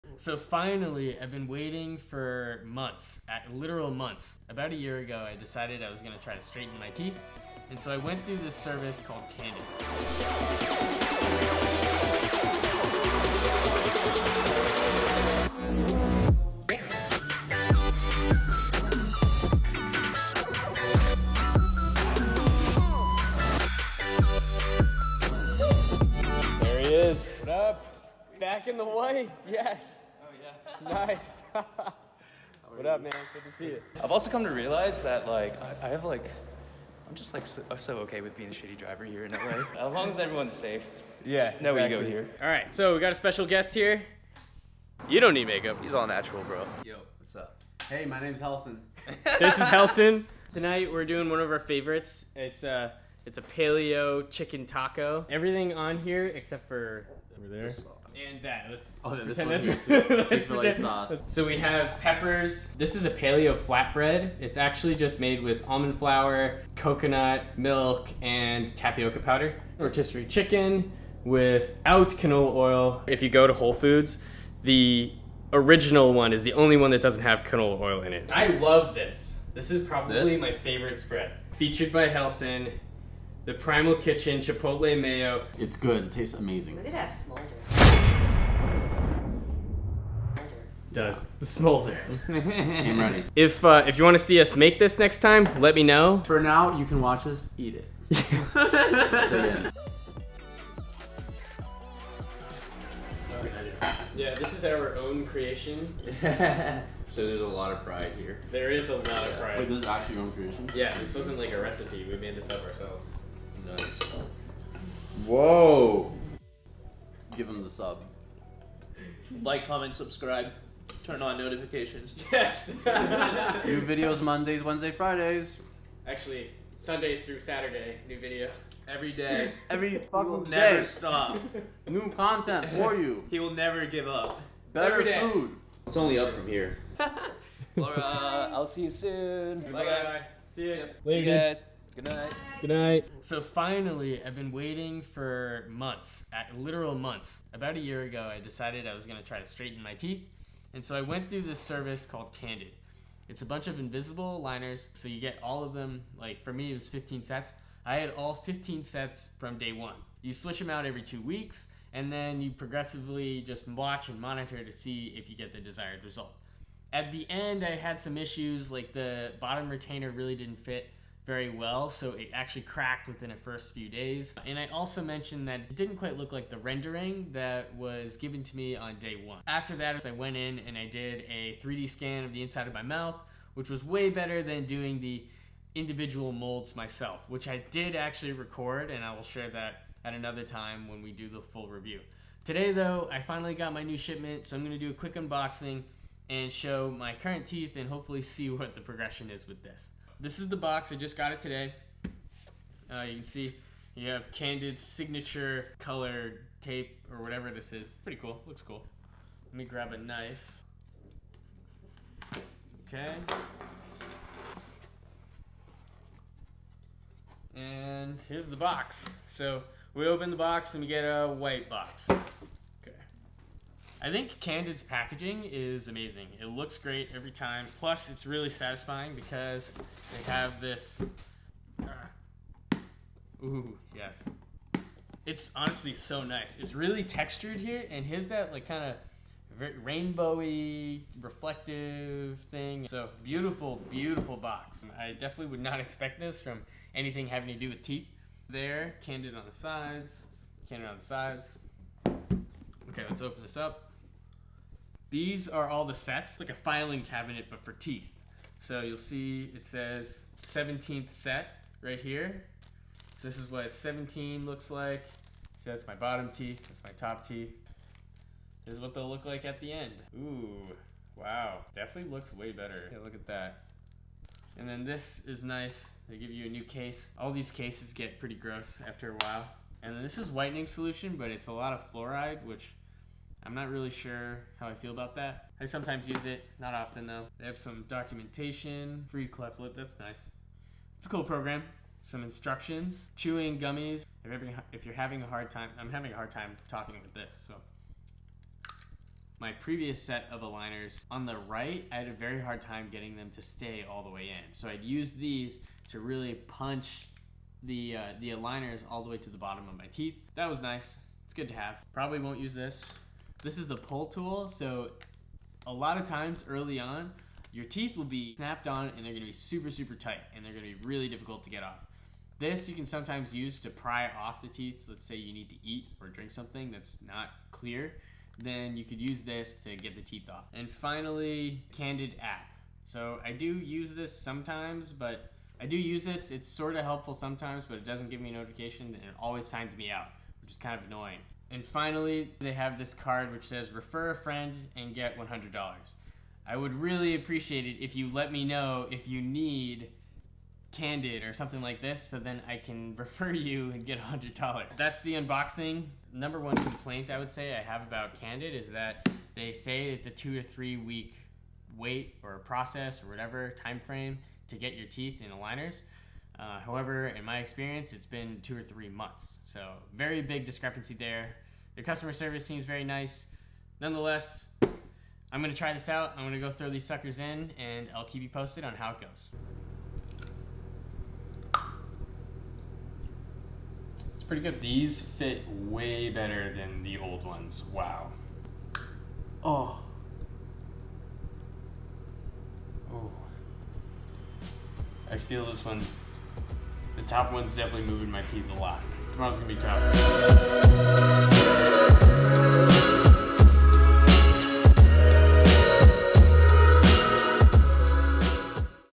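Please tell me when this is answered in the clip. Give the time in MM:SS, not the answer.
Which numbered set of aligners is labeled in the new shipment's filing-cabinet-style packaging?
04:20.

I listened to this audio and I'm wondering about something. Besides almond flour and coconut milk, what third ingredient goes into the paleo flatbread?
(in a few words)
tapioca powder.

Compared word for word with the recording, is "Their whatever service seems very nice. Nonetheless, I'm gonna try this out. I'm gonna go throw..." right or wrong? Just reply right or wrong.
wrong.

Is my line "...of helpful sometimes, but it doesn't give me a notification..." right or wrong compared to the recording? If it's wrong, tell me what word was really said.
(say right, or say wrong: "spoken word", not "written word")
right.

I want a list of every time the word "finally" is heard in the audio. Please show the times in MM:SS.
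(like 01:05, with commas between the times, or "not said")
00:00, 02:23, 03:13, 05:30, 05:41.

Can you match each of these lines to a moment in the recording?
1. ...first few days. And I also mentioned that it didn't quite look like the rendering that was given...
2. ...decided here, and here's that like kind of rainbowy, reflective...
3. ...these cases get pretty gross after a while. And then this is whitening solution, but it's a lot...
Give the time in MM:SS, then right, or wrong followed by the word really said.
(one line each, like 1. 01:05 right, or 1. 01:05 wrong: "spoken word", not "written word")
1. 02:53 right
2. 03:57 wrong: "textured", not "decided"
3. 04:37 right.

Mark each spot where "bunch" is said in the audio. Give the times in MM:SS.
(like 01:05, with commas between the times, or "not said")
02:33.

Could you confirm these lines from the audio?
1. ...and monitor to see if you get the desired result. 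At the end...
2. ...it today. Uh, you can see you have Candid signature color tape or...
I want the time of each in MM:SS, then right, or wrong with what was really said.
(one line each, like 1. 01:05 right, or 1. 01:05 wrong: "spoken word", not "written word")
1. 02:44 right
2. 03:21 right.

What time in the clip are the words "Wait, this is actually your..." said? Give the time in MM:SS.
01:49.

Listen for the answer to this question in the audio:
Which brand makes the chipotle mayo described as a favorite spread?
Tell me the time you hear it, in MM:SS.
01:23.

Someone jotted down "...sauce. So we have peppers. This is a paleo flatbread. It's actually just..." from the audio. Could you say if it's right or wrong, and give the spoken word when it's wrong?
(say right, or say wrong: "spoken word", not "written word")
right.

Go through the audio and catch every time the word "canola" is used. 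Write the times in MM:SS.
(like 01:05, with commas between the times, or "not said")
01:12, 01:17.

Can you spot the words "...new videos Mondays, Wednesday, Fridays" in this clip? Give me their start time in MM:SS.
02:03.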